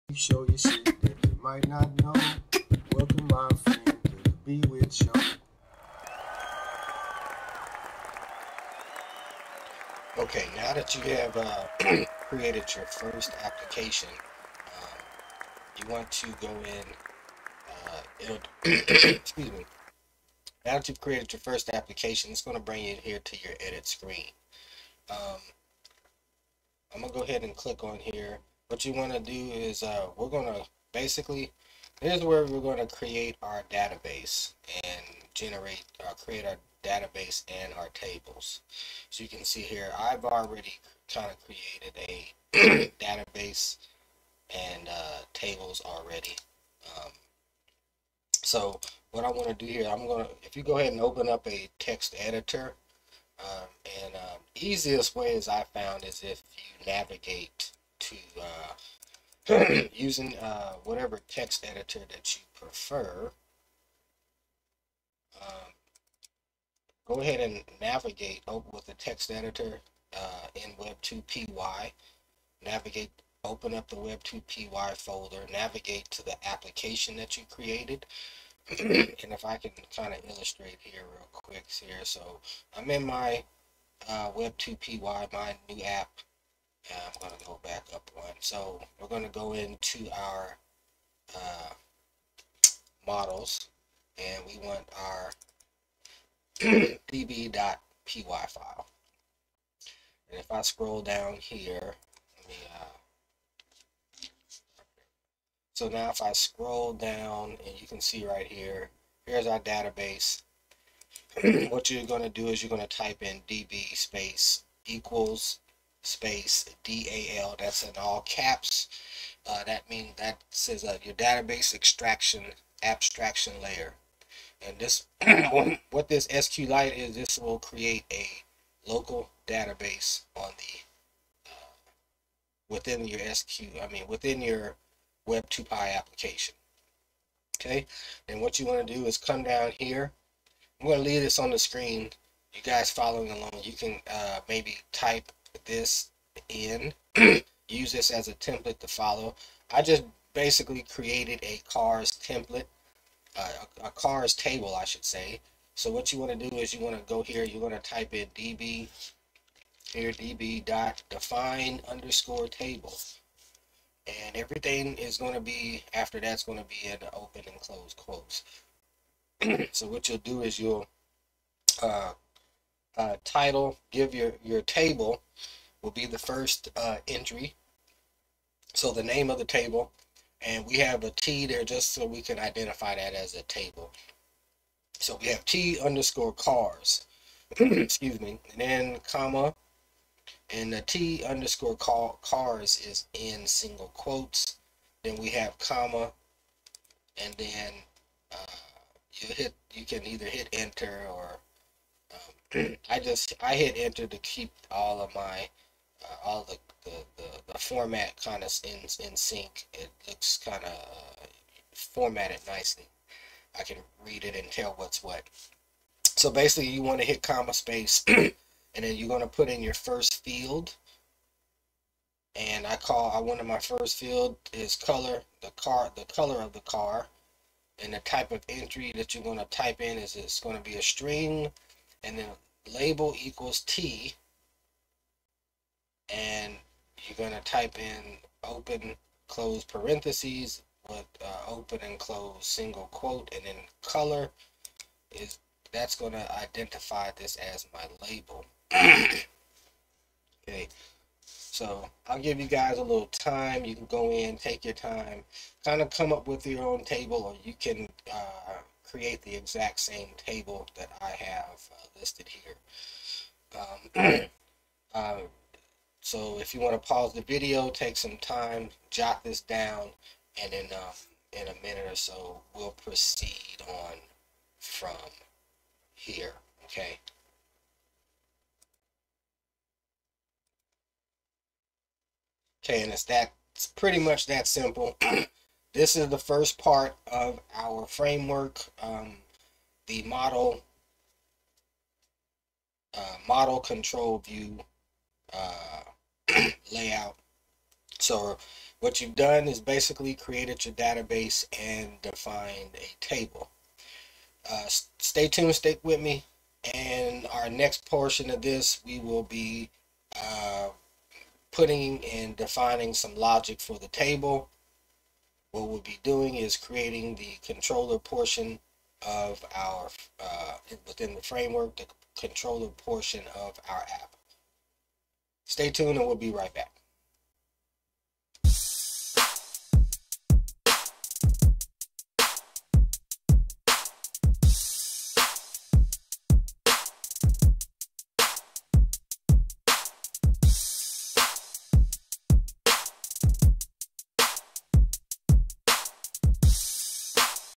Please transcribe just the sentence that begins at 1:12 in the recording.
Navigate, open up the Web2PY folder, navigate to the application that you created.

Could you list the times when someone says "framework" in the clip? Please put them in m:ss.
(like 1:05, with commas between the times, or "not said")
4:47, 5:21.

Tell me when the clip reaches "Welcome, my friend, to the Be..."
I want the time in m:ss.
0:02.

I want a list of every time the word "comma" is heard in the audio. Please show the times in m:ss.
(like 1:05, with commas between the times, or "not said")
3:09, 3:15, 3:37.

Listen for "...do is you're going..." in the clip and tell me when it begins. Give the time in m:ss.
1:52.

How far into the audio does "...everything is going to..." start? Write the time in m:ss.
2:44.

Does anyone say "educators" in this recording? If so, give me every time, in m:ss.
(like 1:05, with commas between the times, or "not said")
not said.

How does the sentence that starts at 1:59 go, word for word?
Uh, that means that says uh, your database extraction abstraction layer.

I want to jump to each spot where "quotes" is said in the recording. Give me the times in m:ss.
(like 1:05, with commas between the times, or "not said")
2:47, 3:13, 4:02.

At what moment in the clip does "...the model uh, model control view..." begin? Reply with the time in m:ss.
4:49.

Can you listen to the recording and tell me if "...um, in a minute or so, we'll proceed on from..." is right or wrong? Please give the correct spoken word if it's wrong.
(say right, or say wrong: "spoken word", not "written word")
right.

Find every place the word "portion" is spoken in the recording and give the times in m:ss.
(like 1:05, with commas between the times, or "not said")
5:07, 5:17, 5:22.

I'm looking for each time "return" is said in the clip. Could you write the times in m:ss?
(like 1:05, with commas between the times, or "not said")
not said.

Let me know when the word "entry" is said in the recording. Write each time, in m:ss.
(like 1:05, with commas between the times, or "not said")
2:57, 3:48.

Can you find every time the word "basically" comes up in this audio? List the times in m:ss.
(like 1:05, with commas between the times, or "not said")
0:30, 2:30, 3:36, 4:59.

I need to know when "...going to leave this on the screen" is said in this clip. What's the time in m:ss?
2:20.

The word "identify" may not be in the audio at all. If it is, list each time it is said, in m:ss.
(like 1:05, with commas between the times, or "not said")
3:02, 4:06.